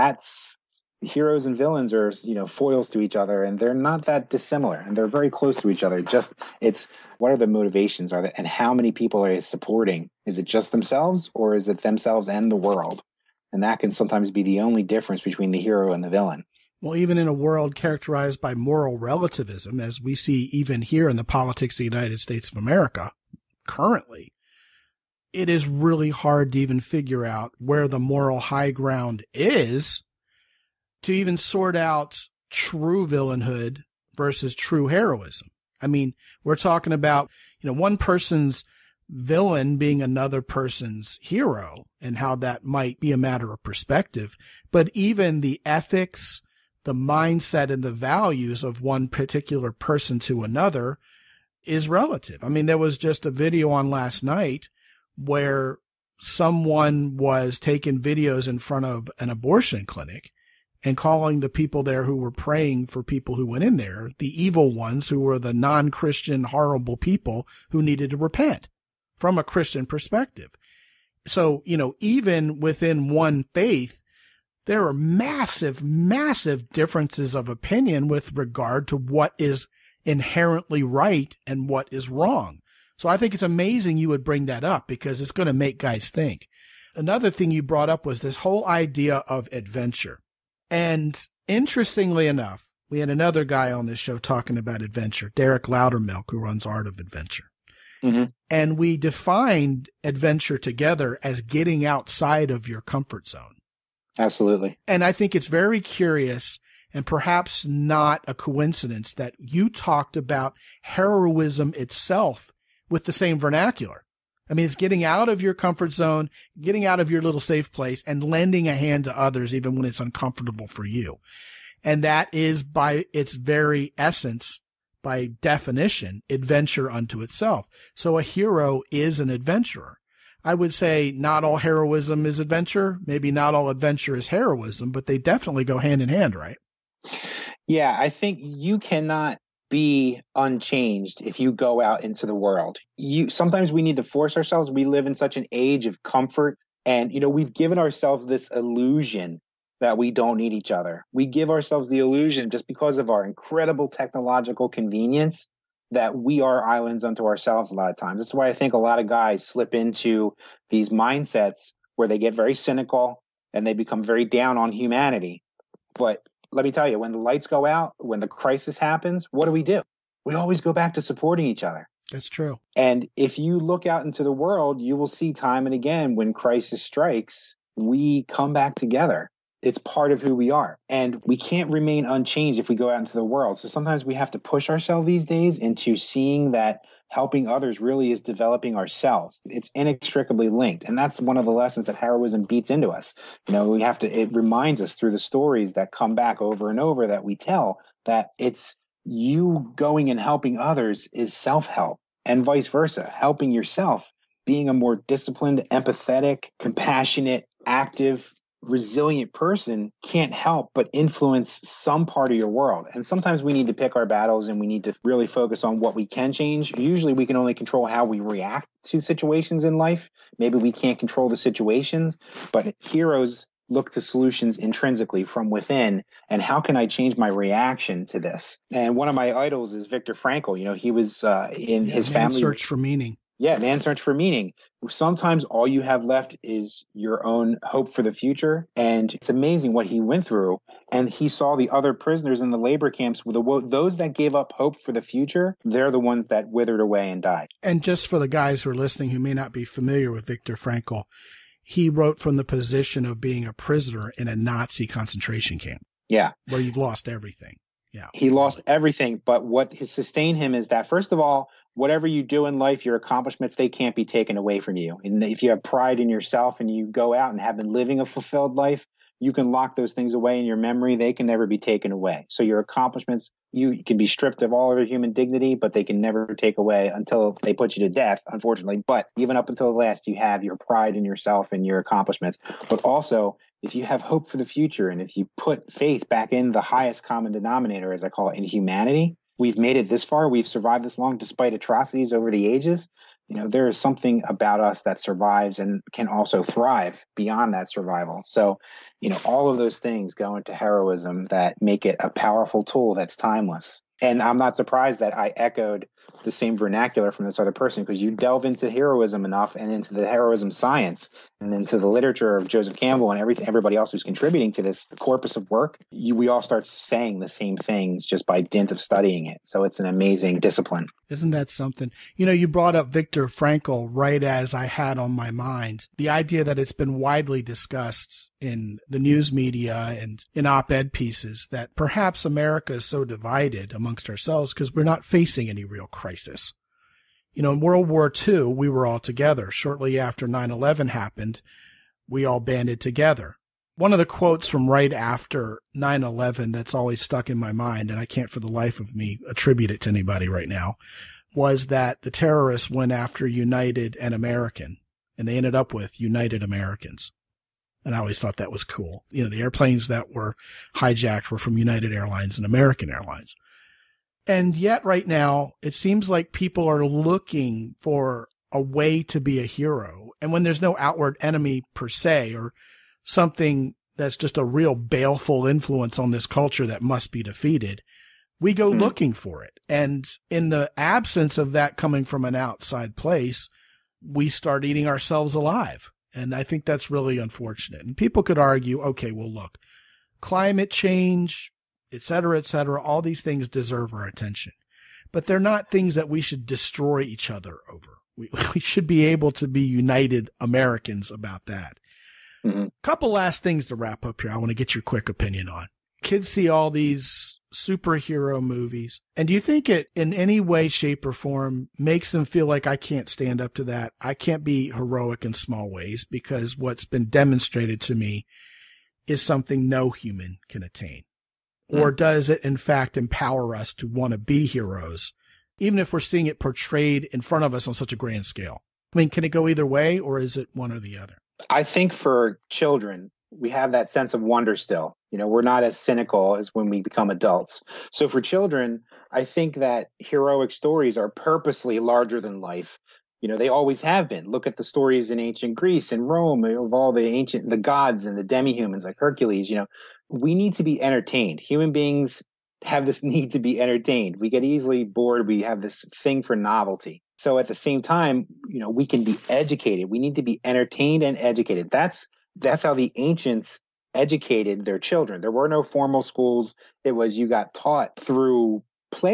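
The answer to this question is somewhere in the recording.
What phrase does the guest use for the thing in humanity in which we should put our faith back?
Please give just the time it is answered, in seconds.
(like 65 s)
286 s.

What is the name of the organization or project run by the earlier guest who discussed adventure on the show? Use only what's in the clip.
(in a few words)
Art of Adventure.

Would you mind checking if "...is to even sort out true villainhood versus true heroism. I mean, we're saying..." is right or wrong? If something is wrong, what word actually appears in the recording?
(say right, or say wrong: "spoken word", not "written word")
wrong: "talking", not "saying".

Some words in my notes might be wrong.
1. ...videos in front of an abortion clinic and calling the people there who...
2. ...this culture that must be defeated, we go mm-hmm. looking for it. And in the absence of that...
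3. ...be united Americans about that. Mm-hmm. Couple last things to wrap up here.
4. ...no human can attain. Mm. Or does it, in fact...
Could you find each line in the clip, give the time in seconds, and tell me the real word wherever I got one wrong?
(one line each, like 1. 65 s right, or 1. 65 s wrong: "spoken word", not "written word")
1. 57 s right
2. 376 s right
3. 399 s right
4. 419 s right.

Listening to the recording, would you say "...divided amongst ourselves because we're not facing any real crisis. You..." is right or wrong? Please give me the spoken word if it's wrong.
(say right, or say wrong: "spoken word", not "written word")
right.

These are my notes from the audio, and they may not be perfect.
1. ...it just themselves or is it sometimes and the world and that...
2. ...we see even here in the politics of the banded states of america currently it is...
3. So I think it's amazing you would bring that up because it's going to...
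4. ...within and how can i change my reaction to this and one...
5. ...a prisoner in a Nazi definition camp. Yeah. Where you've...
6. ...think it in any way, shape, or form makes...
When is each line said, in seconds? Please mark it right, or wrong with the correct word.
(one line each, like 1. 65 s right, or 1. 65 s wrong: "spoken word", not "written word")
1. 10 s wrong: "themselves", not "sometimes"
2. 19 s wrong: "united", not "banded"
3. 82 s right
4. 225 s right
5. 253 s wrong: "concentration", not "definition"
6. 409 s right.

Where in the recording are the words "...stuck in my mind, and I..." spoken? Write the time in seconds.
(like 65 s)
346 s.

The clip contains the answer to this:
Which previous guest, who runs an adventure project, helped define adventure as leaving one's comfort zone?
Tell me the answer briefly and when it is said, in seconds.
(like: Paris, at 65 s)
Derek Loudermilk, at 95 s.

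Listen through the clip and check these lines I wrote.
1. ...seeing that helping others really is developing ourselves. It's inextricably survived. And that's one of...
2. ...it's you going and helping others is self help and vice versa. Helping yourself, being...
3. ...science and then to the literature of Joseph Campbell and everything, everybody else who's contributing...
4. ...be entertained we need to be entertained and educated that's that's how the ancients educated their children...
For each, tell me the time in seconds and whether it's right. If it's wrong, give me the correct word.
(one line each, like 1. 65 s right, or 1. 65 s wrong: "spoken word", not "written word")
1. 185 s wrong: "linked", not "survived"
2. 198 s right
3. 310 s right
4. 459 s wrong: "educated", not "entertained".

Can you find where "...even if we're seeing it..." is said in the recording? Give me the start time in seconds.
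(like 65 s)
425 s.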